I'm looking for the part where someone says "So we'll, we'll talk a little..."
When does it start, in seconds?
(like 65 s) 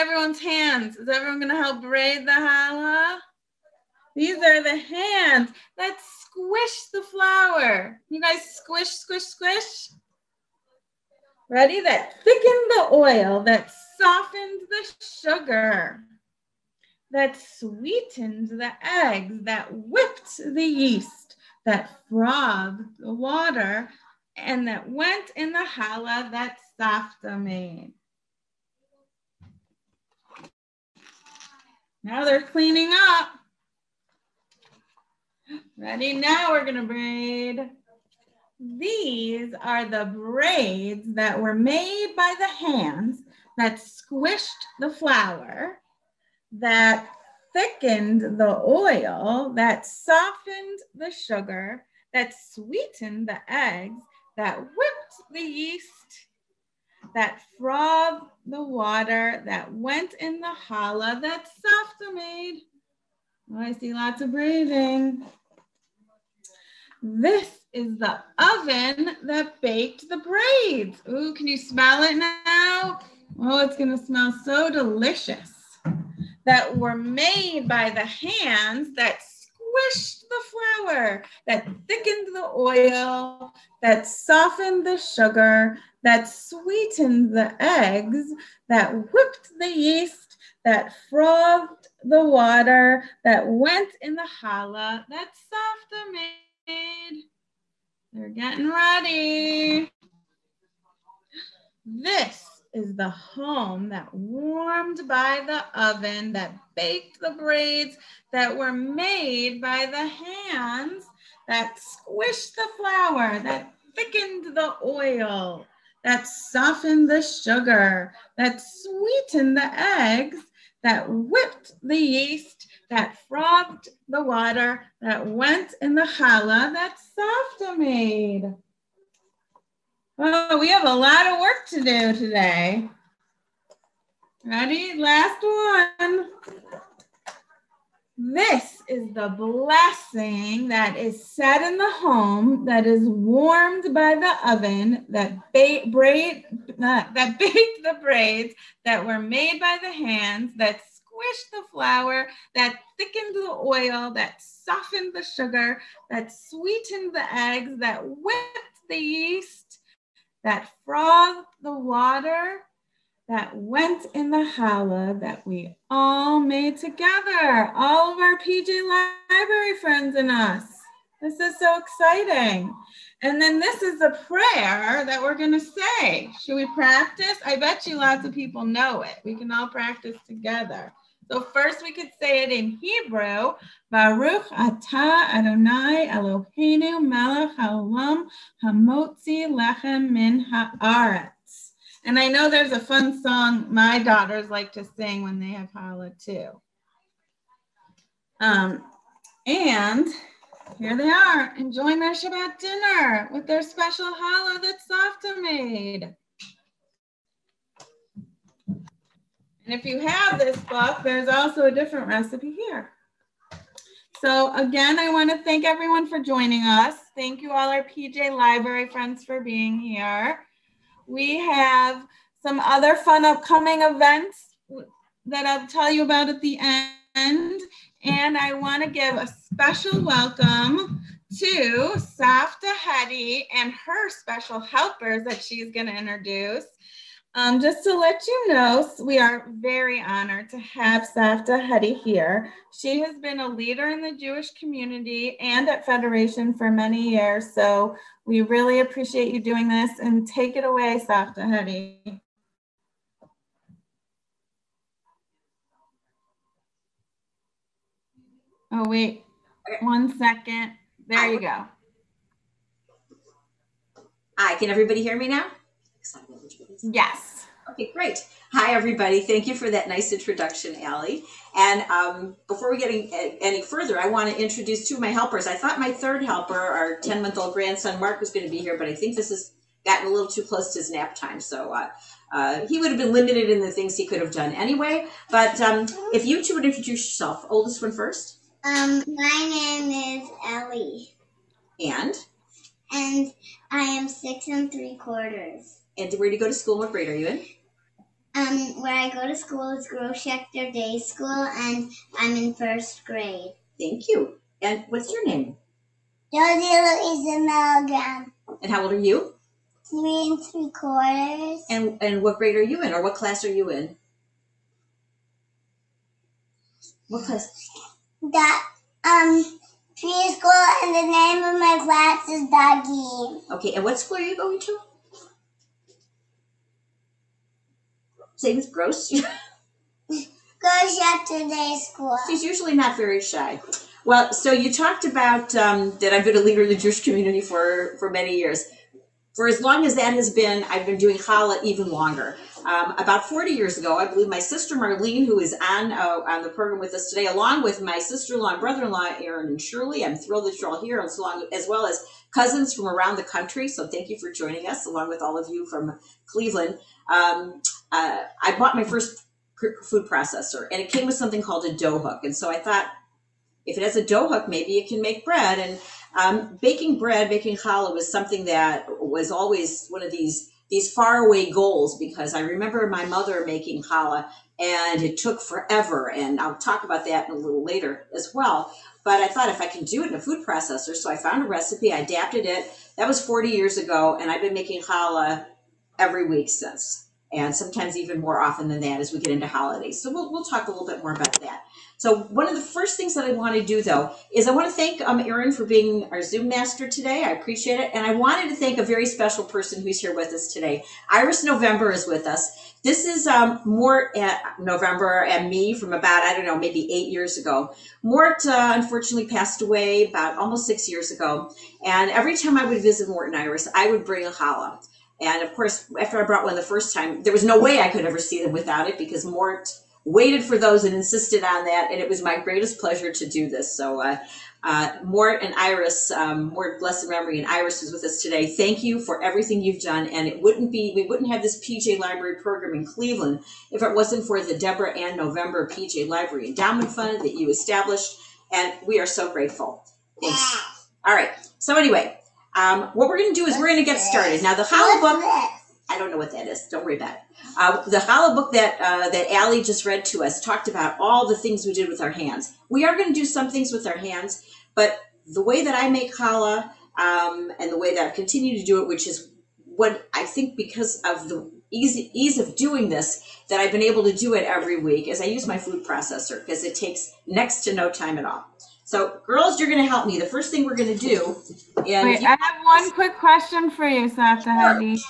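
389 s.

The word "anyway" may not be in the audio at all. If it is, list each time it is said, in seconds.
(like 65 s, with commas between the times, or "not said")
284 s, 441 s.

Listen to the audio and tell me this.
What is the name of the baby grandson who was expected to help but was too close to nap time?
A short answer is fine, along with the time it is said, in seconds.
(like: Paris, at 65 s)
Mark, at 277 s.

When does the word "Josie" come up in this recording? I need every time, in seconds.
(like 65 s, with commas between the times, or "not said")
306 s.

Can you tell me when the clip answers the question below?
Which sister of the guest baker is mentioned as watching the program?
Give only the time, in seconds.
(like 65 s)
344 s.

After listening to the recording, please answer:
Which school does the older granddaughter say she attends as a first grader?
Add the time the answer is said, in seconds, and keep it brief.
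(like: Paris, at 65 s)
Gross Schechter Day School, at 299 s.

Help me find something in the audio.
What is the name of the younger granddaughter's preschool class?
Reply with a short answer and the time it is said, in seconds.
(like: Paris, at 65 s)
Dougie, at 322 s.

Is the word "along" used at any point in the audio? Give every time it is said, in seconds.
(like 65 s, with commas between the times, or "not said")
347 s, 354 s.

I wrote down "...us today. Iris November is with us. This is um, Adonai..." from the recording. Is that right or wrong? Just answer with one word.
wrong.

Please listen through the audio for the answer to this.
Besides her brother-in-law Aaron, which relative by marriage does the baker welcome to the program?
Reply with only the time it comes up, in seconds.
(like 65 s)
349 s.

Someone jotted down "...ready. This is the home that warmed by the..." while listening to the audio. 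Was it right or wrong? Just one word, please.
right.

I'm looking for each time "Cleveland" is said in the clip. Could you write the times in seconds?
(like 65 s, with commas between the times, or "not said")
356 s, 432 s.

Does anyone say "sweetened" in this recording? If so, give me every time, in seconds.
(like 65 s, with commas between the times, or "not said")
17 s, 52 s, 86 s, 118 s, 156 s.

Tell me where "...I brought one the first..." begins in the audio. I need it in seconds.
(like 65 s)
416 s.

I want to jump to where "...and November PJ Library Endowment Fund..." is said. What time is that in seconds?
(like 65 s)
434 s.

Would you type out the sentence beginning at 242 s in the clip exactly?
She has been a leader in the Jewish community and at Federation for many years.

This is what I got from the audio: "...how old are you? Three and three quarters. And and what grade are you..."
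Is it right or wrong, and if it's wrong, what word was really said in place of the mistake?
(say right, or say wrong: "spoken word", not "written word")
right.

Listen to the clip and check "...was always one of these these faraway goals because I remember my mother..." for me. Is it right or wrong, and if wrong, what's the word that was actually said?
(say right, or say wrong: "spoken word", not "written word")
right.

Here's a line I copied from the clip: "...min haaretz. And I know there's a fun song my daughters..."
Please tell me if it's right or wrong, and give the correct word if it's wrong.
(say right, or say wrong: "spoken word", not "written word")
right.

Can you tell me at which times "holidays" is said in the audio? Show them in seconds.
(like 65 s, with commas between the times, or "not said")
389 s.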